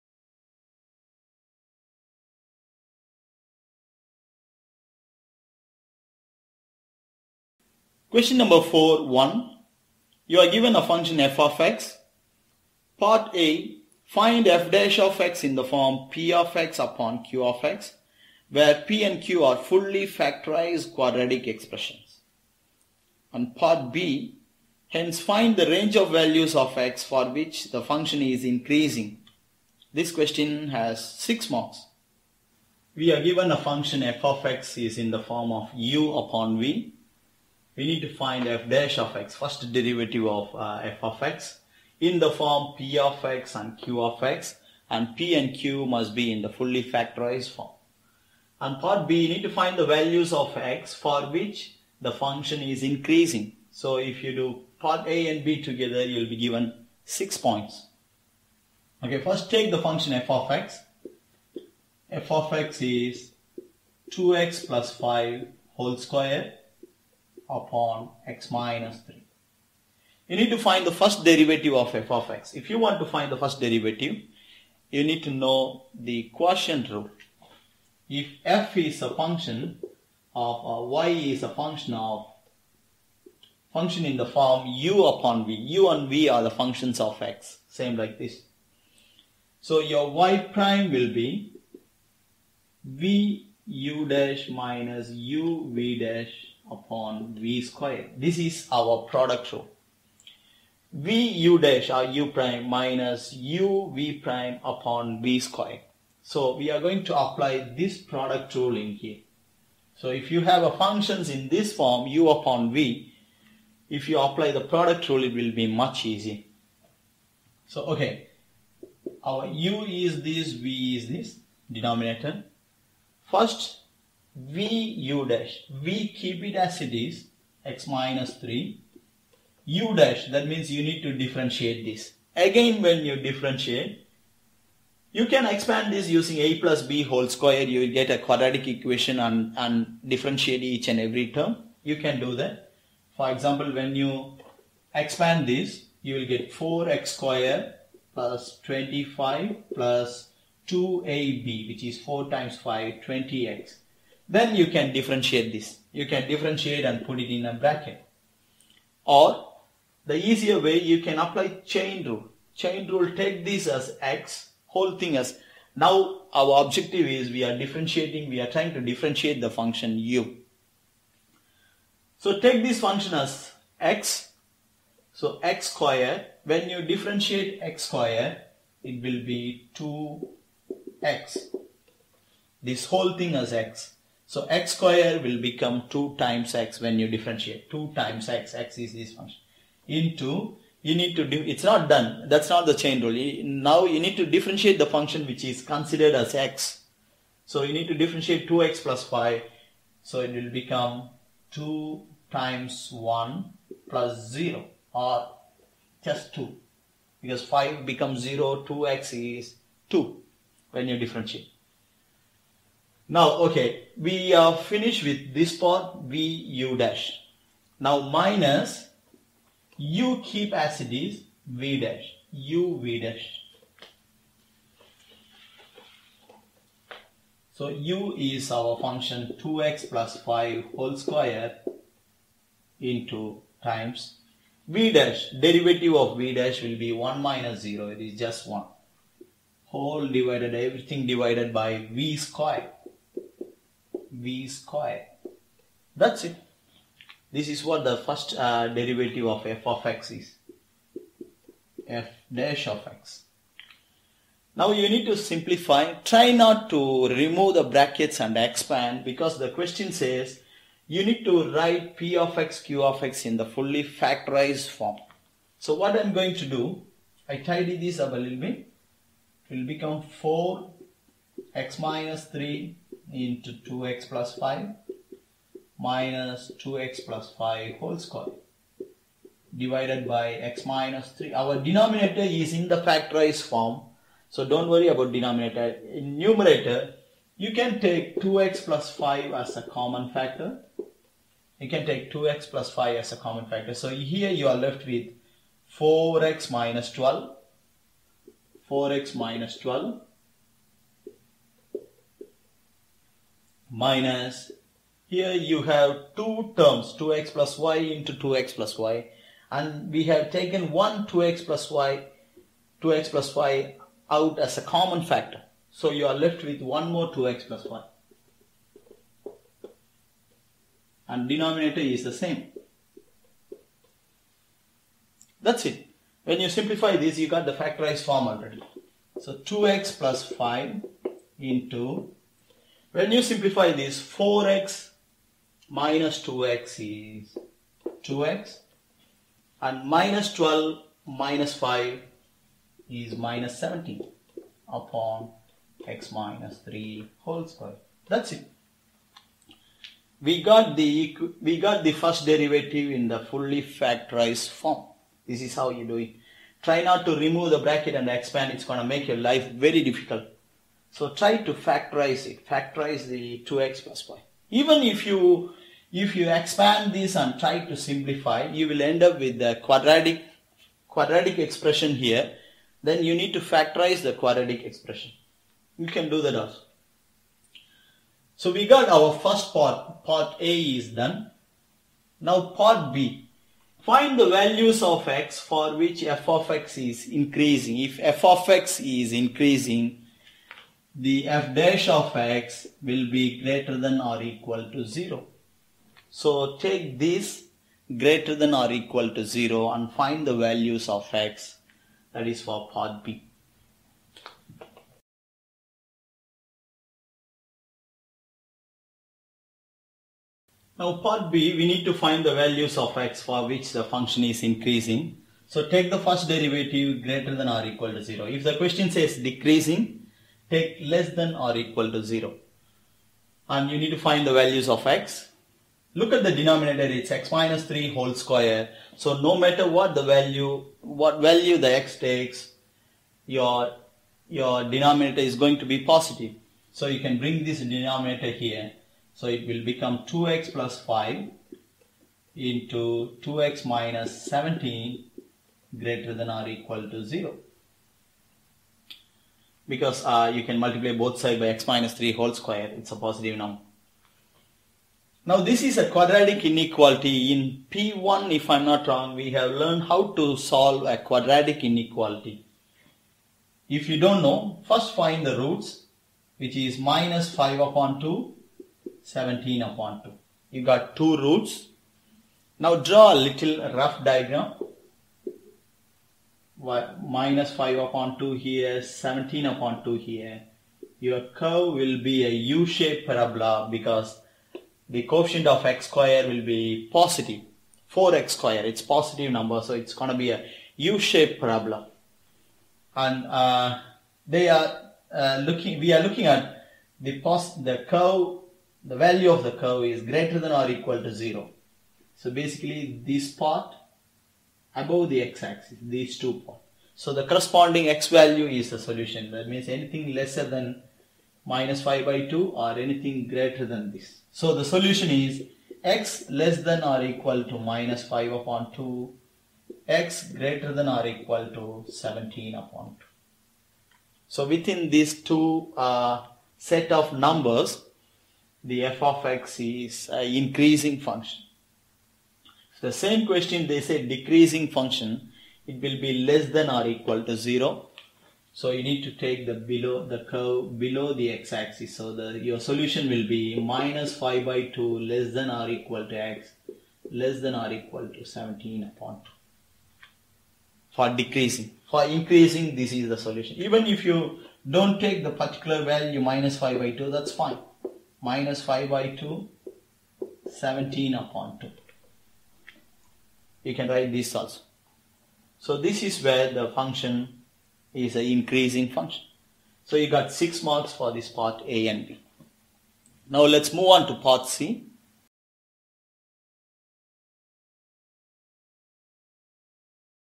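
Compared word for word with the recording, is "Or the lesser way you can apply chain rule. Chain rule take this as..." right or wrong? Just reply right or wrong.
wrong.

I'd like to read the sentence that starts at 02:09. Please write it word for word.
u dash, that means you need to differentiate this.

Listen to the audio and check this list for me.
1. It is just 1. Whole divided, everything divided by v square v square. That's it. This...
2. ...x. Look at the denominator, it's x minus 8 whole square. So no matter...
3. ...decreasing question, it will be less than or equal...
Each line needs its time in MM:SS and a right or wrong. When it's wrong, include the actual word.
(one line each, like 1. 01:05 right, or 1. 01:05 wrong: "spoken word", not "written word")
1. 03:57 right
2. 07:04 wrong: "3", not "8"
3. 08:54 wrong: "function", not "question".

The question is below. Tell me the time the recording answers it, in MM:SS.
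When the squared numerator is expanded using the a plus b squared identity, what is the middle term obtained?
02:33.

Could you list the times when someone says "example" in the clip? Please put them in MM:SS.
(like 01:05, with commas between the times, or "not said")
02:23.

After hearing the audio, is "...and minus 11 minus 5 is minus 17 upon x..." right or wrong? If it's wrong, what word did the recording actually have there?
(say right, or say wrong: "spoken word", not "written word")
wrong: "12", not "11".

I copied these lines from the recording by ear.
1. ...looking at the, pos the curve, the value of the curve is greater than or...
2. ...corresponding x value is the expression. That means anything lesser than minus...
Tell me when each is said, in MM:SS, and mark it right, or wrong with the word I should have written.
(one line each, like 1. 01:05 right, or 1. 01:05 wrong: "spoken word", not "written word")
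1. 08:16 right
2. 08:27 wrong: "solution", not "expression".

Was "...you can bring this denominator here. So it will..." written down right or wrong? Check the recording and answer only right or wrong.
right.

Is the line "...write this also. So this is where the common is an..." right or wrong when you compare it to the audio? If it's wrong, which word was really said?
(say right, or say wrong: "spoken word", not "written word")
wrong: "function", not "common".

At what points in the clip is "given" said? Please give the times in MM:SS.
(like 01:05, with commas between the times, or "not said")
00:10, 00:33, 00:56.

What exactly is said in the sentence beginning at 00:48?
And part b, you need to find the values of x for which the function is increasing.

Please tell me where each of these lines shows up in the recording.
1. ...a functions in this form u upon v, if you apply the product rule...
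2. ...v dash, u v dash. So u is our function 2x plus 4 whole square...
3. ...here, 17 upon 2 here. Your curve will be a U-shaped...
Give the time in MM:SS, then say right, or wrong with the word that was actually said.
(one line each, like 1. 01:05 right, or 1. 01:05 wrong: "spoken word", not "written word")
1. 01:50 right
2. 03:41 wrong: "5", not "4"
3. 07:58 right.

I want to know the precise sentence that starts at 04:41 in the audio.
Our denominator is in the factorized form.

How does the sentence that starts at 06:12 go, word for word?
Then you need to factorize the quadratic expression.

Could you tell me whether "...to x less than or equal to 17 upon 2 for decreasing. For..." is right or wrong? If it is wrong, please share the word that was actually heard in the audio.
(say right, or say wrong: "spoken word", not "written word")
right.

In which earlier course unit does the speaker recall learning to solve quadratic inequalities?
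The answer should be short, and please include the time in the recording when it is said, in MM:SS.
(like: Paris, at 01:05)
P1, at 07:37.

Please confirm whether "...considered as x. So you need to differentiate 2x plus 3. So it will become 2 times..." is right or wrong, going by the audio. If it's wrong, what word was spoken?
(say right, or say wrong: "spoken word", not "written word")
wrong: "5", not "3".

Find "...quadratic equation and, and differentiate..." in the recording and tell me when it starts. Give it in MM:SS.
02:18.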